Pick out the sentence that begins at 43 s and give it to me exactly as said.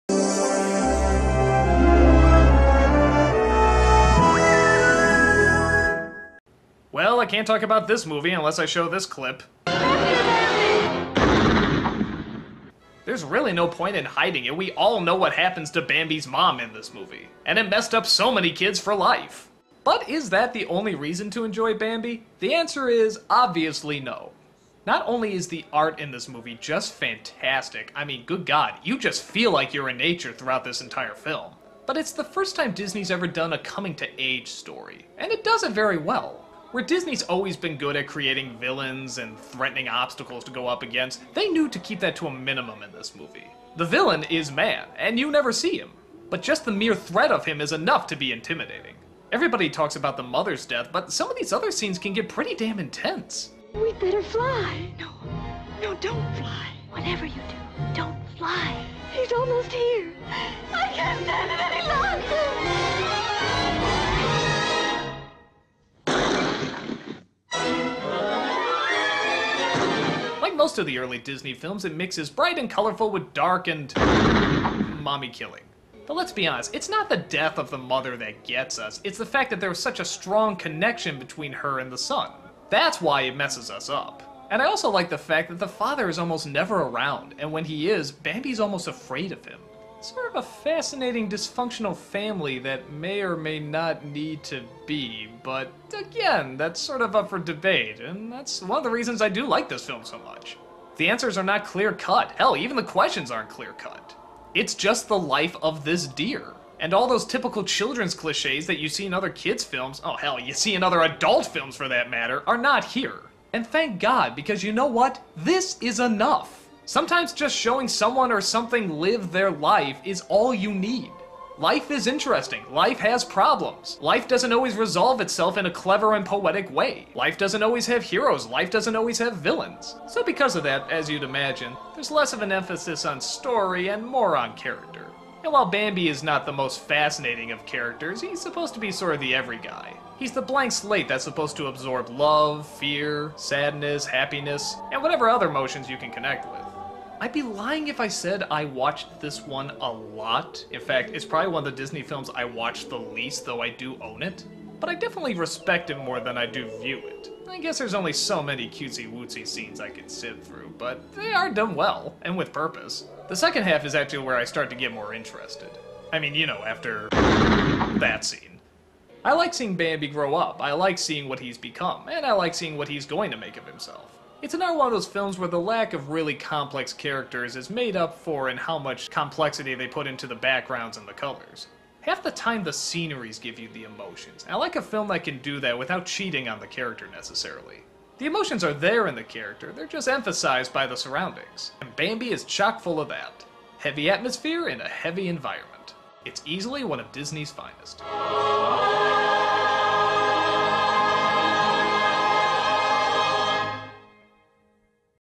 The villain is man, and you never see him, but just the mere threat of him is enough to be intimidating.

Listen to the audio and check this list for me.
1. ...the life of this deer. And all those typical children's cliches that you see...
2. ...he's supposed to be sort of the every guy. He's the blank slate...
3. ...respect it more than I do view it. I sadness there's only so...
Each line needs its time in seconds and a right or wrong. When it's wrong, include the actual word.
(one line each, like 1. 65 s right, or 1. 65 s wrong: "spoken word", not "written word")
1. 105 s right
2. 138 s right
3. 155 s wrong: "guess", not "sadness".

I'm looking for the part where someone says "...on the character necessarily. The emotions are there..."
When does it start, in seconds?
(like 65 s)
186 s.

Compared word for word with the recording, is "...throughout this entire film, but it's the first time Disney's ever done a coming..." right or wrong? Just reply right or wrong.
right.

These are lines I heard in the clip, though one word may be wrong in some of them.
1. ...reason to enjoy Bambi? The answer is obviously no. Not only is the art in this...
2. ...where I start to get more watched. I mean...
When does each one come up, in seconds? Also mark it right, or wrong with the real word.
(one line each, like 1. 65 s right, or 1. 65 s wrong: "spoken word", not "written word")
1. 20 s right
2. 164 s wrong: "interested", not "watched".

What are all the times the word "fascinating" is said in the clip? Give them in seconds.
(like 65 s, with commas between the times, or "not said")
90 s, 136 s.